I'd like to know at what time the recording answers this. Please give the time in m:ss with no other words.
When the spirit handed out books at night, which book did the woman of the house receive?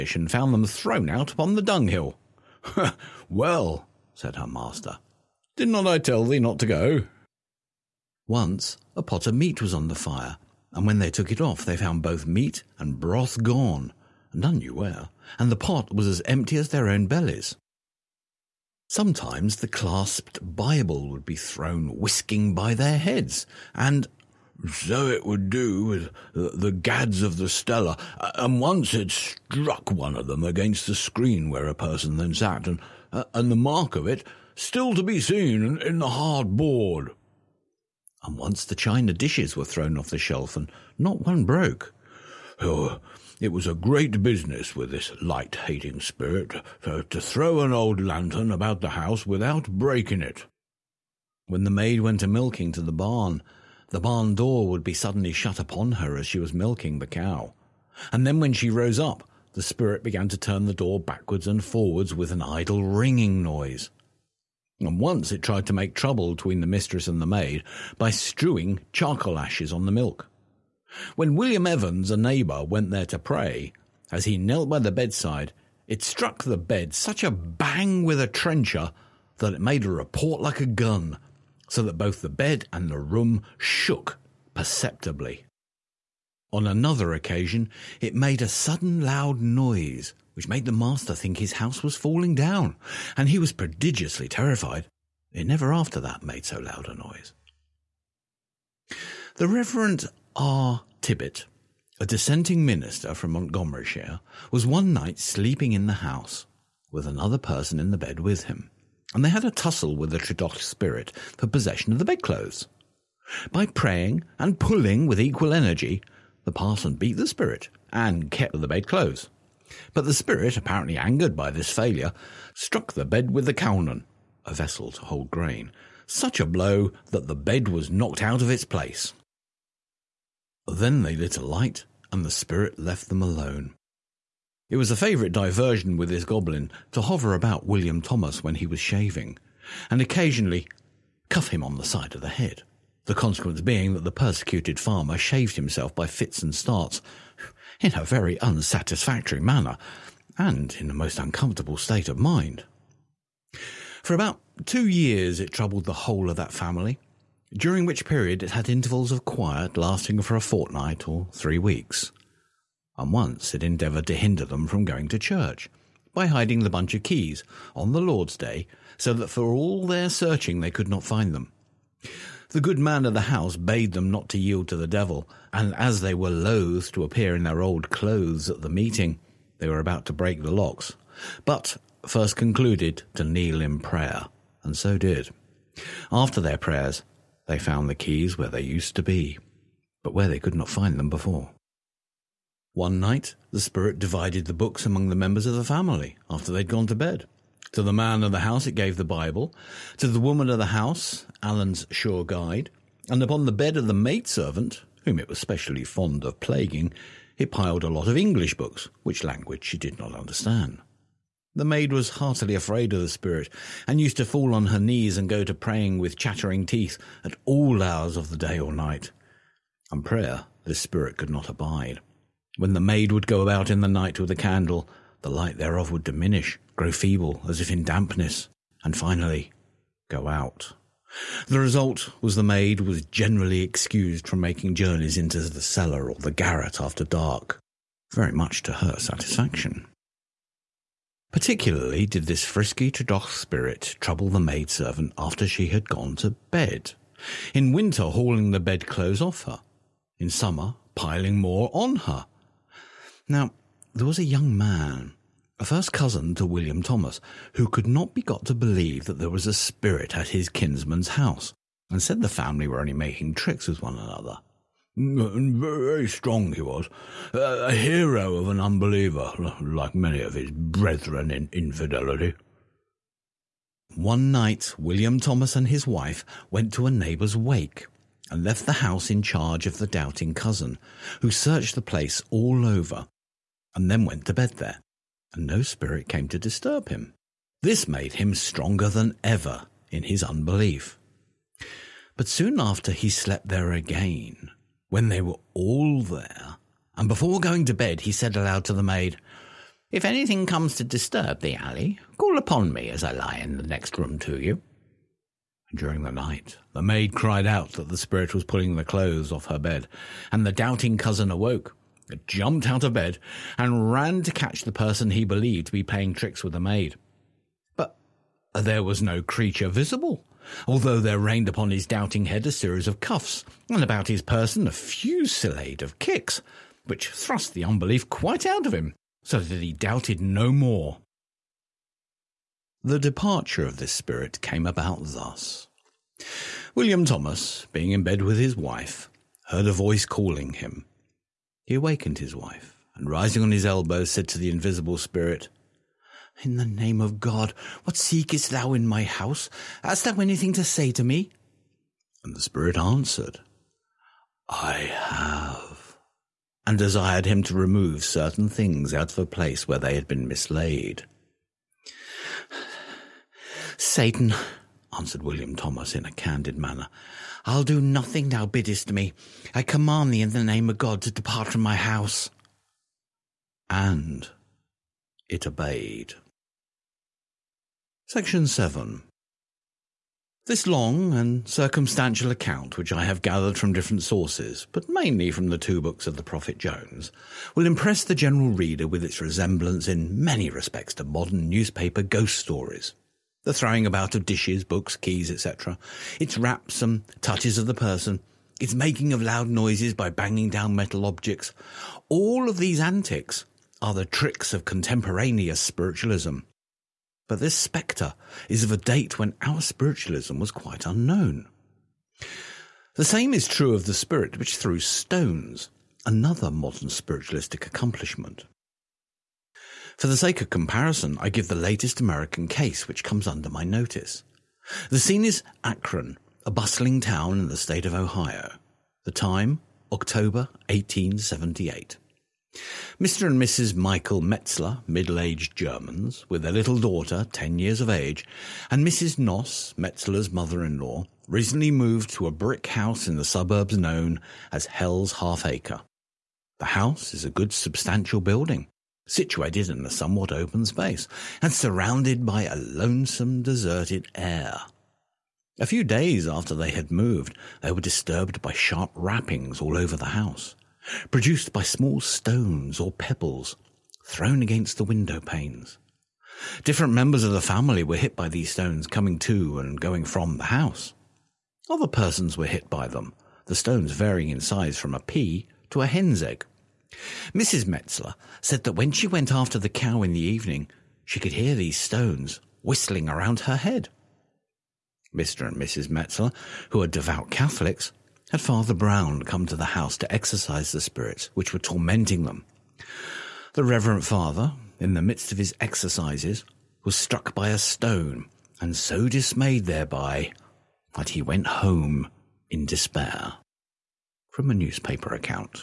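3:21.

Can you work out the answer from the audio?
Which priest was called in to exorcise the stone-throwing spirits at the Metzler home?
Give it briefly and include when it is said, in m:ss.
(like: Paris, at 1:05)
Father Brown, at 8:08.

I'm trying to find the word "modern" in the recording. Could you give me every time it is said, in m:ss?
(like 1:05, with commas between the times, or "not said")
6:31, 6:56.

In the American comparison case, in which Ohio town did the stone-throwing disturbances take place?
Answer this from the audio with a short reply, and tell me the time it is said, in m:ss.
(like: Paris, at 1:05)
Akron, at 7:05.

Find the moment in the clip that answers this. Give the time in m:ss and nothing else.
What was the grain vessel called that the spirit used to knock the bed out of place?
2:03.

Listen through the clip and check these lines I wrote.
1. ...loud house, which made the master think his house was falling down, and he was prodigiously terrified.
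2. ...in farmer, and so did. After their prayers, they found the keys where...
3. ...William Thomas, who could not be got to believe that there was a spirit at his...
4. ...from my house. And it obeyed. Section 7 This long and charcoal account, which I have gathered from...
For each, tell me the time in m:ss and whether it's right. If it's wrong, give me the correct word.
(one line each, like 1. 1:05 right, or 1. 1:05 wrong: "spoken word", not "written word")
1. 1:29 wrong: "noise", not "house"
2. 3:03 wrong: "prayer", not "farmer"
3. 4:16 right
4. 6:11 wrong: "circumstantial", not "charcoal".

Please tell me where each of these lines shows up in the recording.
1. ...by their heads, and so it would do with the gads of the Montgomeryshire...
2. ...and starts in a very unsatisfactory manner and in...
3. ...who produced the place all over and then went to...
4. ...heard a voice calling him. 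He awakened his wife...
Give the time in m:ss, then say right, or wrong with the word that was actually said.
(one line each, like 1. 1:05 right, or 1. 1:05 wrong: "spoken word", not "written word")
1. 0:22 wrong: "Stella", not "Montgomeryshire"
2. 2:26 right
3. 4:41 wrong: "searched", not "produced"
4. 5:39 right.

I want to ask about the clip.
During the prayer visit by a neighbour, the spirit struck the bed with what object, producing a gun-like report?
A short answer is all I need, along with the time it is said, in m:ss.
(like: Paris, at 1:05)
A trencher, at 1:18.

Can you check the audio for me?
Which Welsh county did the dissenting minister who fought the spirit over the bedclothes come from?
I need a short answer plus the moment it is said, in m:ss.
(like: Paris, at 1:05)
Montgomeryshire, at 1:43.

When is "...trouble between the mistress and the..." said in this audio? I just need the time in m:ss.
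1:05.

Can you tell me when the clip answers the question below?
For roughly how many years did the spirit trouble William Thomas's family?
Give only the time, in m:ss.
2:34.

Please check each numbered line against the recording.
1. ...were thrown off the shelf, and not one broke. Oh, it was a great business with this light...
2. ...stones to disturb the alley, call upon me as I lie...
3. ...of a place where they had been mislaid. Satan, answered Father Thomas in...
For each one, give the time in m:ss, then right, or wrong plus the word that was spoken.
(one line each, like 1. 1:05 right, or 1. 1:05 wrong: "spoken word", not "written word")
1. 0:39 right
2. 5:00 wrong: "comes", not "stones"
3. 5:59 wrong: "William", not "Father".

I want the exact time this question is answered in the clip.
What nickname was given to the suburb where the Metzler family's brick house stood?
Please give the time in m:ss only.
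7:24.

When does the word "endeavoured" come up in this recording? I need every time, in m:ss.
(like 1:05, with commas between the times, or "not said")
2:43.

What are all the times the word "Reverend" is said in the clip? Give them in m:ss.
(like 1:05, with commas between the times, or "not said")
1:39, 8:13.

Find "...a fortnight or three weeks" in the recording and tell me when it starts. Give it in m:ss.
2:40.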